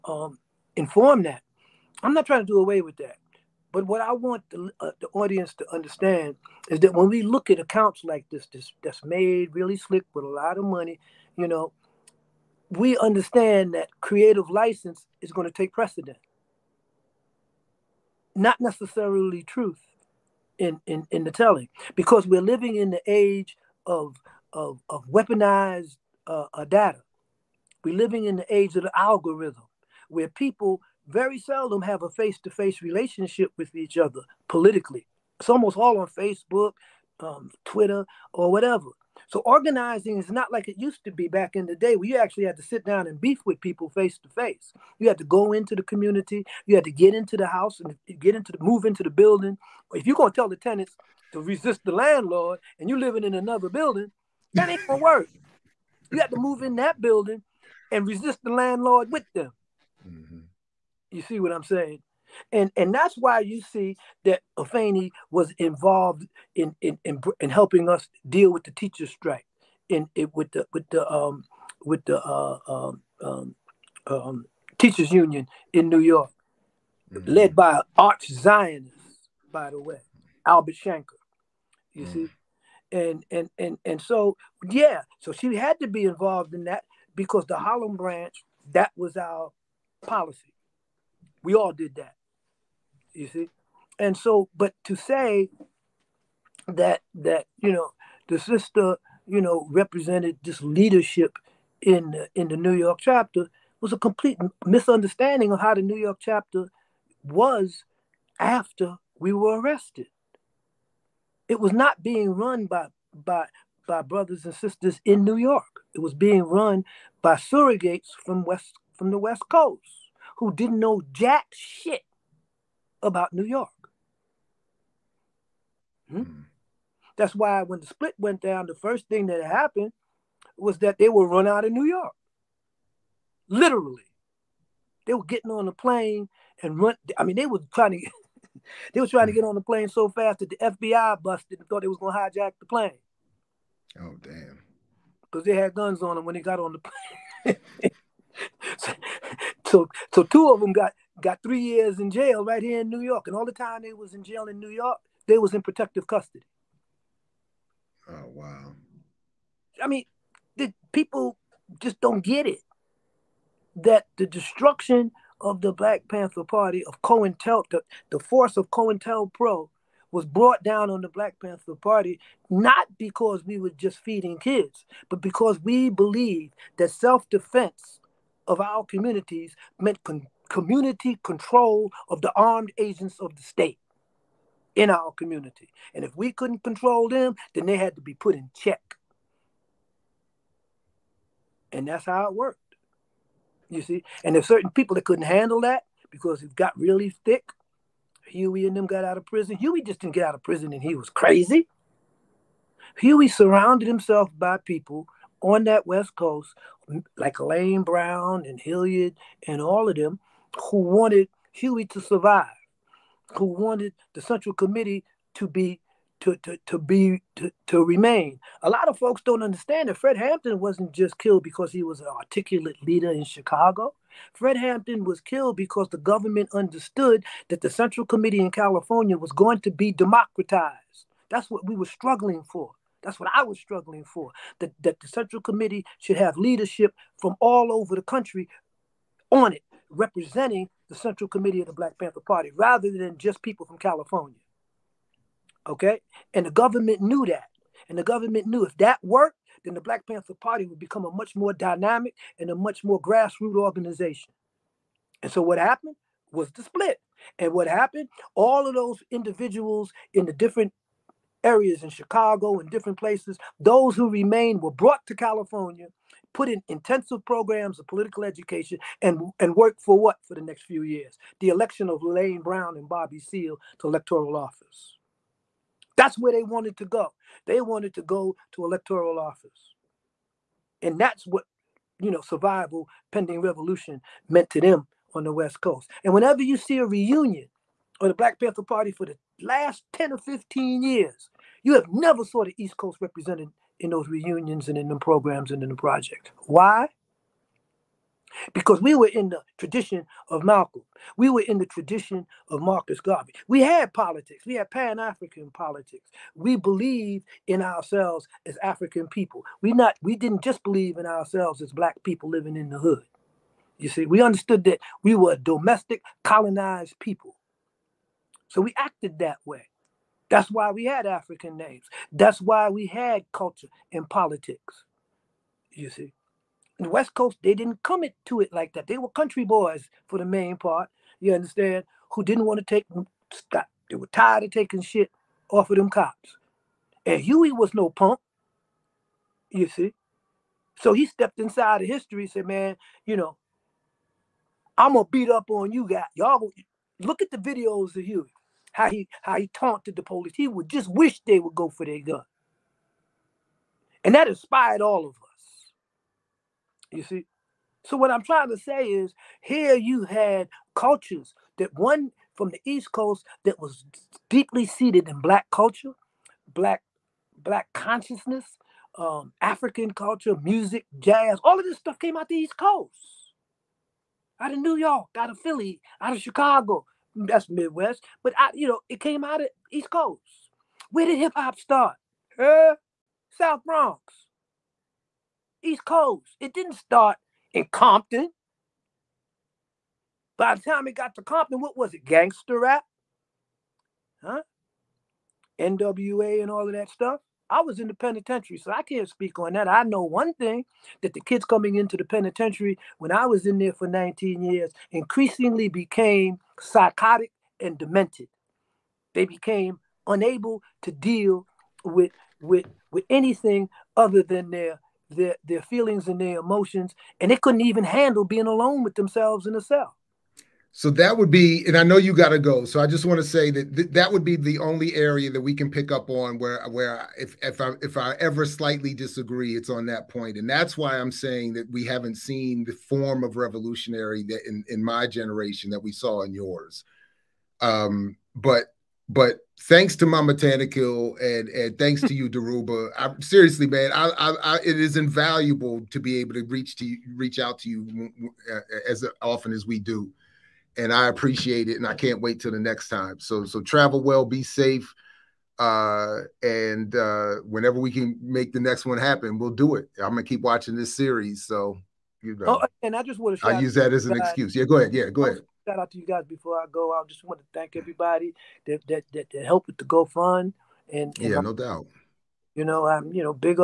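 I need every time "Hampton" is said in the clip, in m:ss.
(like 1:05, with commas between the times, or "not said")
3:40, 3:44.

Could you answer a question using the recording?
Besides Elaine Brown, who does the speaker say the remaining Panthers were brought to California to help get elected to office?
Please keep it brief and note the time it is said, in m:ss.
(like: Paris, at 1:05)
Bobby Seale, at 4:32.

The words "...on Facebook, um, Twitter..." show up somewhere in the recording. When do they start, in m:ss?
0:35.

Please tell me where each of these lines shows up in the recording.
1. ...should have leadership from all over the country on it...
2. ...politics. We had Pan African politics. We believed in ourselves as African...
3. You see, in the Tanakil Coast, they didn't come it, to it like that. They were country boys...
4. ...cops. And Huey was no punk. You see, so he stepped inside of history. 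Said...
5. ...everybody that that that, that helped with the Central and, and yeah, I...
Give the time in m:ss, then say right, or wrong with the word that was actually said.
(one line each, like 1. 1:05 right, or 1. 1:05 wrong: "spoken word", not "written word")
1. 3:55 right
2. 5:03 right
3. 5:25 wrong: "West", not "Tanakil"
4. 5:35 right
5. 7:47 wrong: "GoFund", not "Central".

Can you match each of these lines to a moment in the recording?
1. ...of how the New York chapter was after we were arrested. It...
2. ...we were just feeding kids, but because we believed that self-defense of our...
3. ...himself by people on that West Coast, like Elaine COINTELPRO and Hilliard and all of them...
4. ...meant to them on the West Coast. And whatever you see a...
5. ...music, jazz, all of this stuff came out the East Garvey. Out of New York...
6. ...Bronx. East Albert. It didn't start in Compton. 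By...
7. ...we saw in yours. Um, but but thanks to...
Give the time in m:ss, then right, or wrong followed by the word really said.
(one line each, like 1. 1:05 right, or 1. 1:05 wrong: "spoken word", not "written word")
1. 1:45 right
2. 2:53 right
3. 3:23 wrong: "Brown", not "COINTELPRO"
4. 4:44 wrong: "whenever", not "whatever"
5. 6:10 wrong: "Coast", not "Garvey"
6. 6:23 wrong: "Coast", not "Albert"
7. 7:15 right.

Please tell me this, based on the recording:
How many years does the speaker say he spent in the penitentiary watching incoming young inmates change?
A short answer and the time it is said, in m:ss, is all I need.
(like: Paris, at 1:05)
19, at 6:43.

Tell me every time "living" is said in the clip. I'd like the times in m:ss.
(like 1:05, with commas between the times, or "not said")
0:22, 0:27, 0:52, 5:12.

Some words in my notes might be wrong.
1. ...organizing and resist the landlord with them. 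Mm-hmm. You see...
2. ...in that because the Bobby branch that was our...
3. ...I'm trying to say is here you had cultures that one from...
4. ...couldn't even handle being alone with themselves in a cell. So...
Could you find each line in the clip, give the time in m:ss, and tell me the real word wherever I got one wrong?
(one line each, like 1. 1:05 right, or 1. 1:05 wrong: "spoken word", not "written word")
1. 0:56 wrong: "building", not "organizing"
2. 1:26 wrong: "Harlem", not "Bobby"
3. 5:58 right
4. 6:57 right.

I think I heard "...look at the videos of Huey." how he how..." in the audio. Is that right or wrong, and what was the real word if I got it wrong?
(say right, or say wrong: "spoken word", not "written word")
right.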